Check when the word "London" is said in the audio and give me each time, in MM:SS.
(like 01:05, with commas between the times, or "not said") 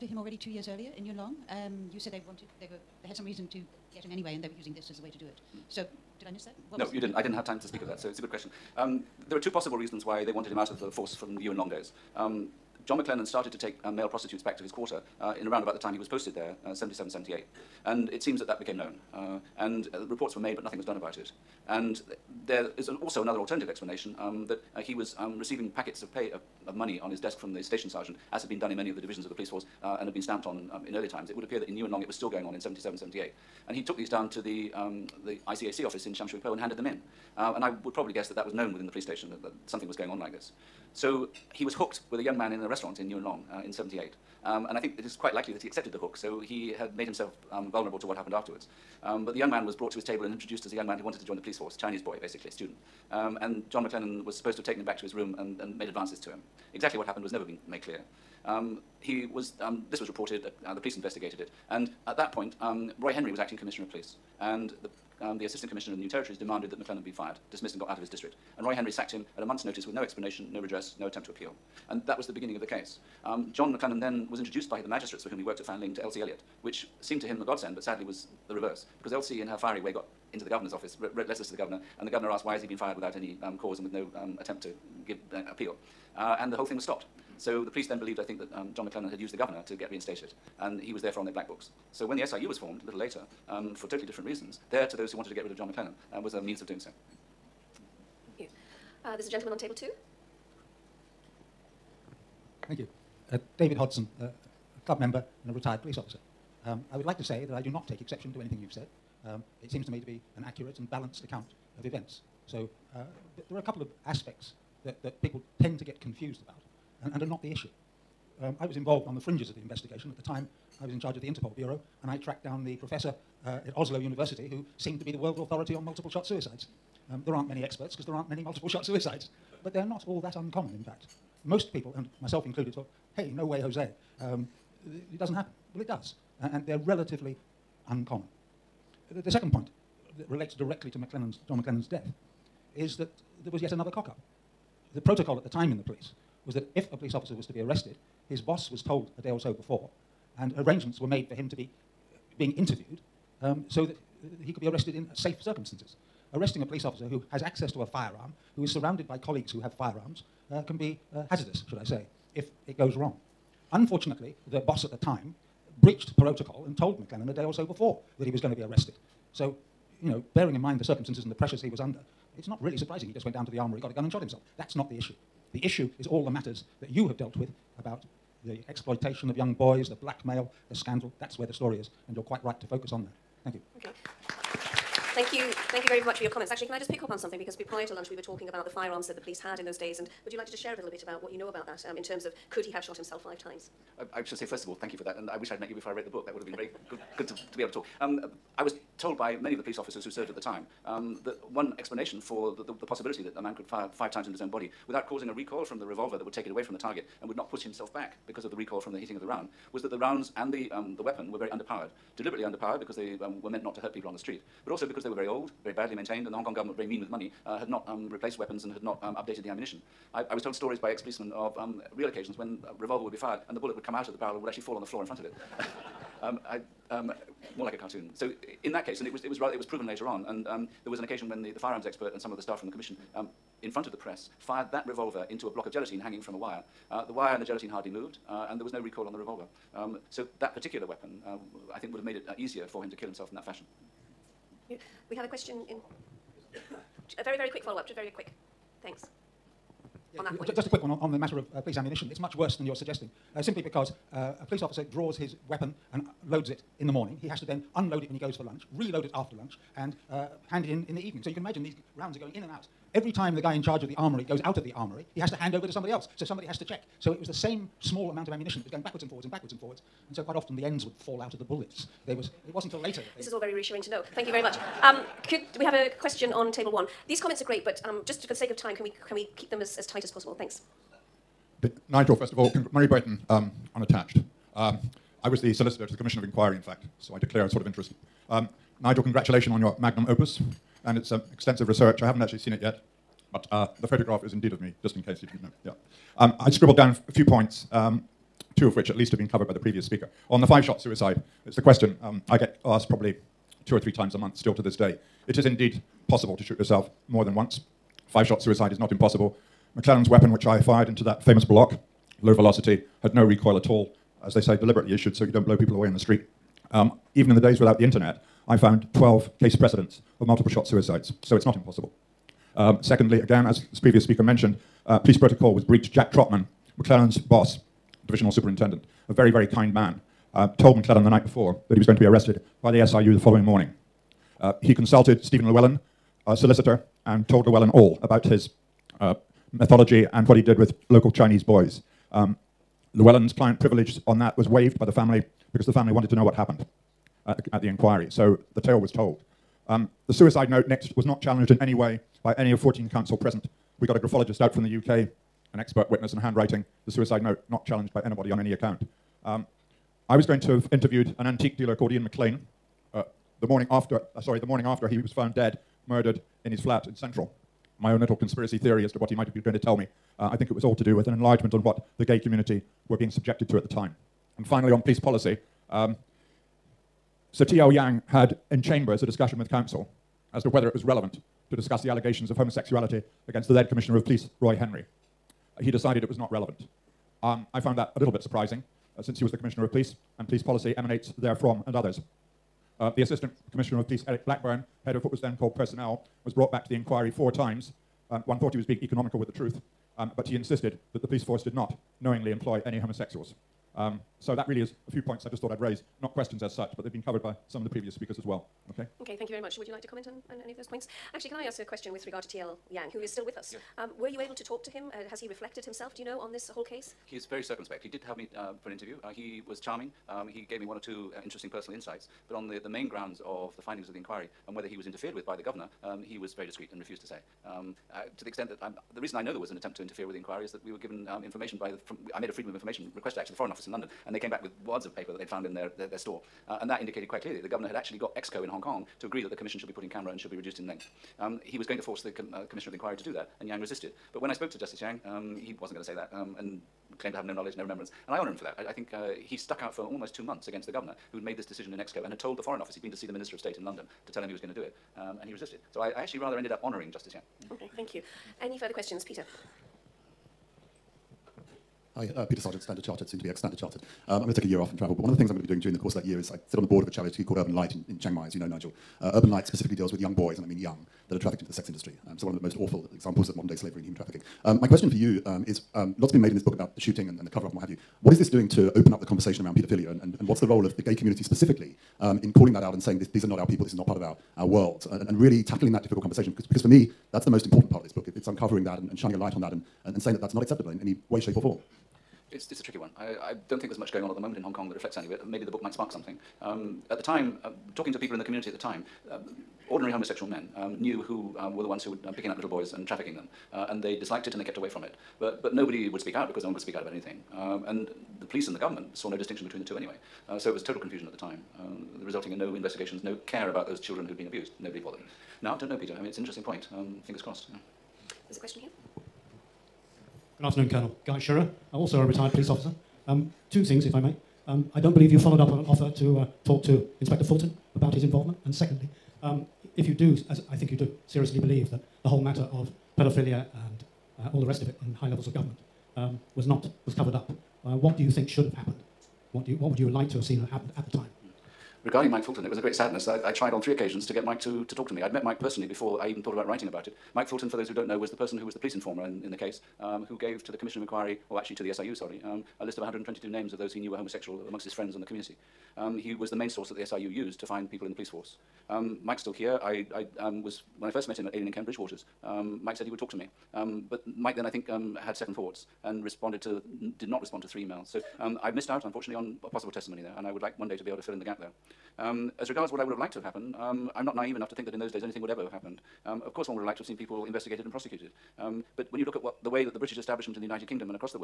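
07:13, 07:33.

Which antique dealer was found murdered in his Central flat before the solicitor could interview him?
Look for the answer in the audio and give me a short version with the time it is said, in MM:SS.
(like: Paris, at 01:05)
Ian McLean, at 06:01.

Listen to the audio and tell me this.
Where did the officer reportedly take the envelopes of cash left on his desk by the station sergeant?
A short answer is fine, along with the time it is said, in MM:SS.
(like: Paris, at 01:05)
ICAC office in Shamshui, at 00:35.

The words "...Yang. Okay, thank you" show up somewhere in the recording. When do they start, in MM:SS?
07:37.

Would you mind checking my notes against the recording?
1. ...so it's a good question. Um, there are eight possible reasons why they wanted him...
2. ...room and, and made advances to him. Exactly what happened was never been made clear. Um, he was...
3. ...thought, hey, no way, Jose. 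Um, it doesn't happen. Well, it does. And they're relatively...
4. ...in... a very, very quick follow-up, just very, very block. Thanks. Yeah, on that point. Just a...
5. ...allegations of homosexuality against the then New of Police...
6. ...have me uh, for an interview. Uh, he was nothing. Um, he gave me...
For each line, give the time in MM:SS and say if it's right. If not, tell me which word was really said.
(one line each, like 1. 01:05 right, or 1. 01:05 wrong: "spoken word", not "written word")
1. 00:07 wrong: "two", not "eight"
2. 00:55 right
3. 02:12 right
4. 04:05 wrong: "quick", not "block"
5. 06:21 wrong: "Commissioner", not "New"
6. 06:58 wrong: "charming", not "nothing".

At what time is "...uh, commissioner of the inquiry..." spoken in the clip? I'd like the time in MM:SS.
07:22.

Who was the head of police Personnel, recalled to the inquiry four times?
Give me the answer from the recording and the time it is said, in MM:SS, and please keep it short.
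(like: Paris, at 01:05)
Eric Blackburn, at 06:34.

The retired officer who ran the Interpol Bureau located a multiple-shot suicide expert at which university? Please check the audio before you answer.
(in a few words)
Oslo University.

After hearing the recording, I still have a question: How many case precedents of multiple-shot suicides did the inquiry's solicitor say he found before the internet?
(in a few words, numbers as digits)
12.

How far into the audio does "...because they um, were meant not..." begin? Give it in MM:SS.
03:32.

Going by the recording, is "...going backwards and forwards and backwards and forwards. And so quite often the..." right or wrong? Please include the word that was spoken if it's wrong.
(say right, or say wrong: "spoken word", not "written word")
right.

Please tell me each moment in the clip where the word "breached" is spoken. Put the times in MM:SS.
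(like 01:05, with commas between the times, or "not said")
02:45, 05:25.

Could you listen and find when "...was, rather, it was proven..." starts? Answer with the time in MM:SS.
03:49.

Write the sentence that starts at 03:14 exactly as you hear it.
I, should say, first of all, thank you for that.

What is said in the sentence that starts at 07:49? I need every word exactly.
Uh, Urban Light specifically deals with young boys, and I mean young, that are trafficked into the sex industry.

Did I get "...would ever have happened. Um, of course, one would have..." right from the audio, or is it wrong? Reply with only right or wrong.
right.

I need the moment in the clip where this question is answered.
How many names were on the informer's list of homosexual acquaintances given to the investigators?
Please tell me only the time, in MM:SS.
09:12.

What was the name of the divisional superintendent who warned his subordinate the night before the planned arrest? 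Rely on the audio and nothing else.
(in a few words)
Jack Trotman.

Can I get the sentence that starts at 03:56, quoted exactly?
Uh, the wire and the gelatine hardly moved, uh, and there was no recoil on the revolver.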